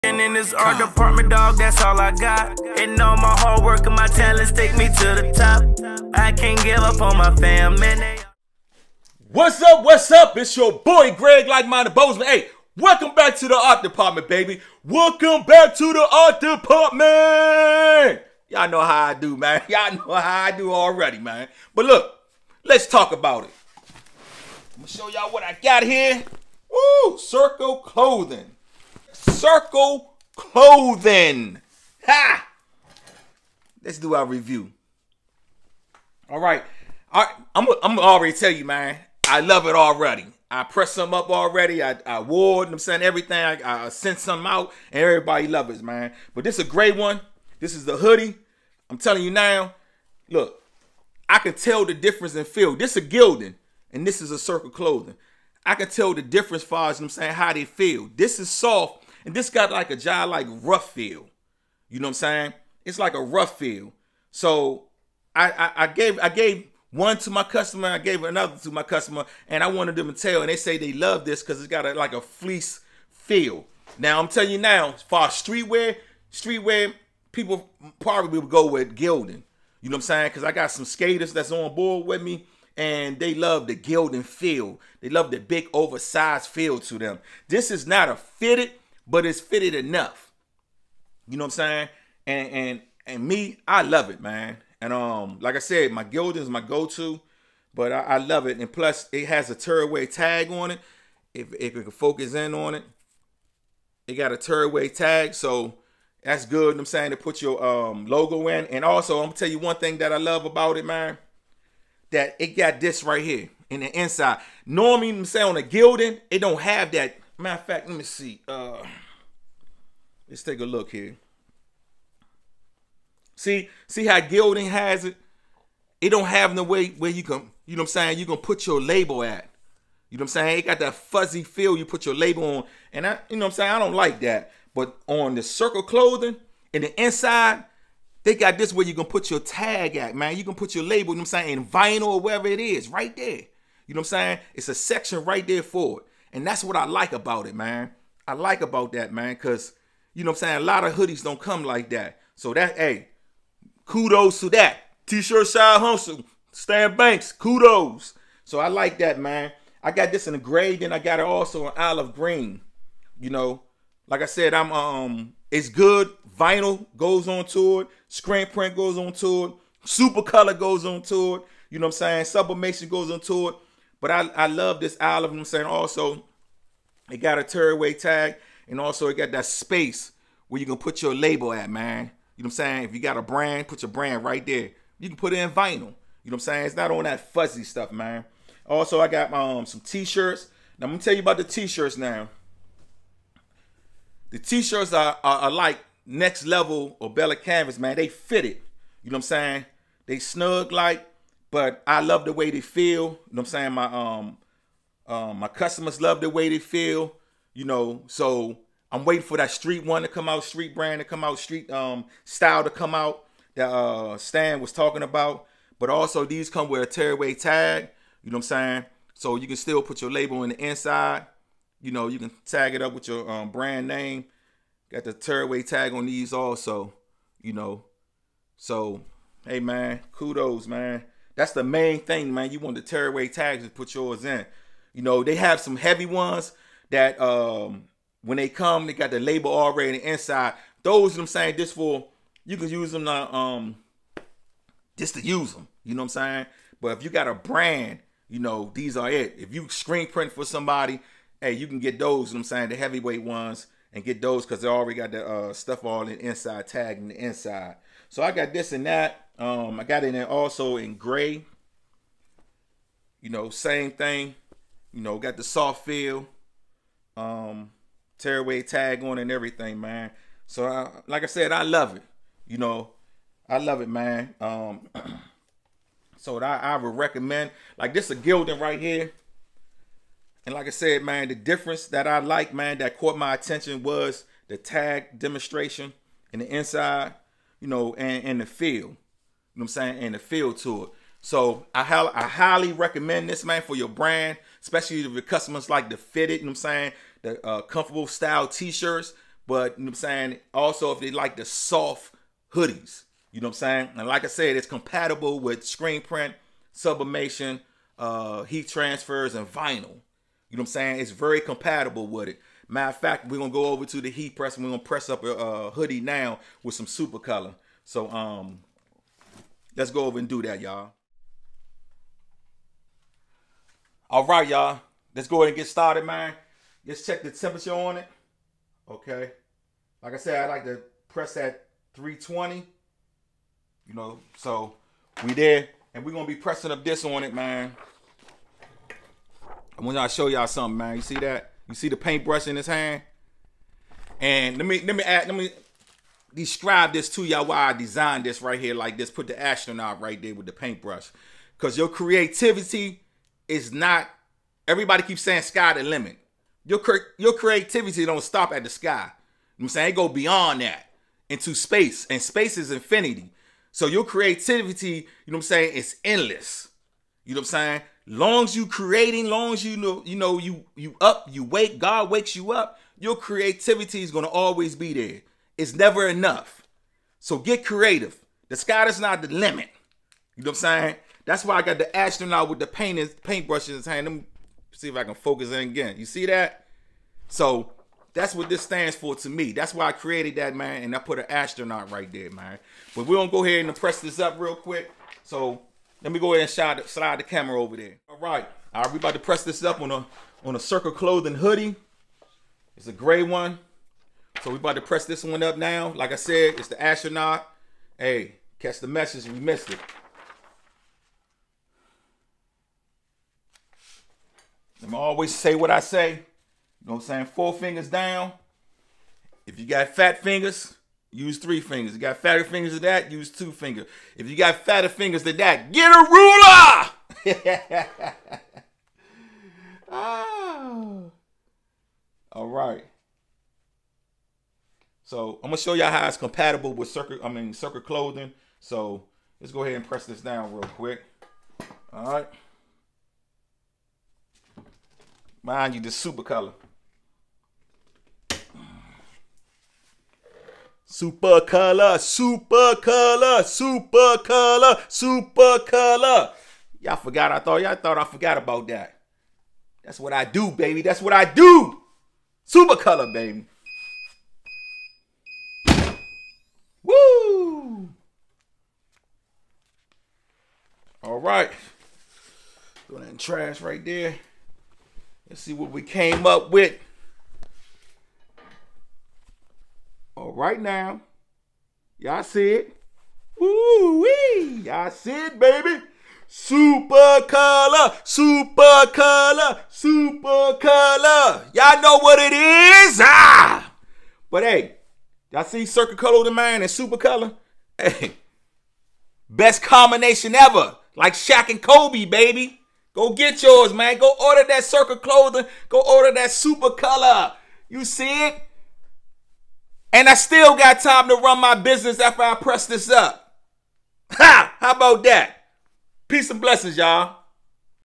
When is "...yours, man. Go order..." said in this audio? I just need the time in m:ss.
8:23.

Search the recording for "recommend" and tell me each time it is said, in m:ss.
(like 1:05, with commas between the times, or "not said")
4:36, 4:52.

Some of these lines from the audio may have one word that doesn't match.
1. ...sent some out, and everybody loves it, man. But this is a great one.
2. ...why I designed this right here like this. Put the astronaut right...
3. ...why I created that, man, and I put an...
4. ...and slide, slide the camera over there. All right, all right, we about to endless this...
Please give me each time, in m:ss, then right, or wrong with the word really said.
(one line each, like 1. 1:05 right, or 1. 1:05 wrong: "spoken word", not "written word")
1. 0:43 right
2. 5:47 right
3. 6:29 right
4. 6:36 wrong: "press", not "endless".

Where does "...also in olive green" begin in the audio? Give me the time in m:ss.
2:41.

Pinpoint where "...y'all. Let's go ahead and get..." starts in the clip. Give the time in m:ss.
5:24.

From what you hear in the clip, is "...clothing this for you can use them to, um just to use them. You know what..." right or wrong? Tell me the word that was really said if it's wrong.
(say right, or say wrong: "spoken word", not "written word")
wrong: "saying", not "clothing".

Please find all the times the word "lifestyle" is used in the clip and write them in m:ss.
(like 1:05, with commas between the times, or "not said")
not said.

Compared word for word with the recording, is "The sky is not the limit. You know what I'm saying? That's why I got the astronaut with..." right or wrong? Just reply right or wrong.
right.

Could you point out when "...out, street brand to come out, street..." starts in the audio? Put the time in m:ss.
3:30.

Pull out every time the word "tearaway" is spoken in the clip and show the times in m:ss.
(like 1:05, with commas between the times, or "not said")
1:39, 1:44, 2:57, 3:36, 3:45, 3:52, 4:28.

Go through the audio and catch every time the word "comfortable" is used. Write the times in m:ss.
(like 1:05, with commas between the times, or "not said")
4:57.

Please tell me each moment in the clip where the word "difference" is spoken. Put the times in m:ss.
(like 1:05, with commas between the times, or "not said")
0:51, 0:56, 4:41.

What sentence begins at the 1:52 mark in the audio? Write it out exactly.
That it got this right here in the inside.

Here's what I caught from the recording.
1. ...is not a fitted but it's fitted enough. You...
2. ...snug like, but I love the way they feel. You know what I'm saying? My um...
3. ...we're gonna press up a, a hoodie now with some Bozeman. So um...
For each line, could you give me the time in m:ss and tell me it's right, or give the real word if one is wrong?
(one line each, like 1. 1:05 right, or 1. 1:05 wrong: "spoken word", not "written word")
1. 1:27 right
2. 3:20 right
3. 5:14 wrong: "Supacolor", not "Bozeman".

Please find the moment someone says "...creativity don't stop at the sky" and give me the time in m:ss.
5:57.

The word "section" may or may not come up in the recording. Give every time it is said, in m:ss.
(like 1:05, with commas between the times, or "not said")
2:24.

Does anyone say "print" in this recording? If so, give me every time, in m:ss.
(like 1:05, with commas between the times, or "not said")
2:48, 4:10, 5:06.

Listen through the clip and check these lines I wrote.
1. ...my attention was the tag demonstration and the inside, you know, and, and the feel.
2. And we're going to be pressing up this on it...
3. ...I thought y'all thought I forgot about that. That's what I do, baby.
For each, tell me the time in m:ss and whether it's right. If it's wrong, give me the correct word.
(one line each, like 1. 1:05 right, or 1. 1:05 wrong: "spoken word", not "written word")
1. 4:43 right
2. 5:35 right
3. 7:37 right.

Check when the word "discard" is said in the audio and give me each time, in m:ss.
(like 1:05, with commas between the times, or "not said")
not said.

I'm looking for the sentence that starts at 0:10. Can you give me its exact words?
It's your boy Greg Like-Minded Bozeman.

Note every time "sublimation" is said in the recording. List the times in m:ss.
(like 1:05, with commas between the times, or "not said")
2:52, 5:06.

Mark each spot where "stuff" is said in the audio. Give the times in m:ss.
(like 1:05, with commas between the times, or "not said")
3:07, 4:15.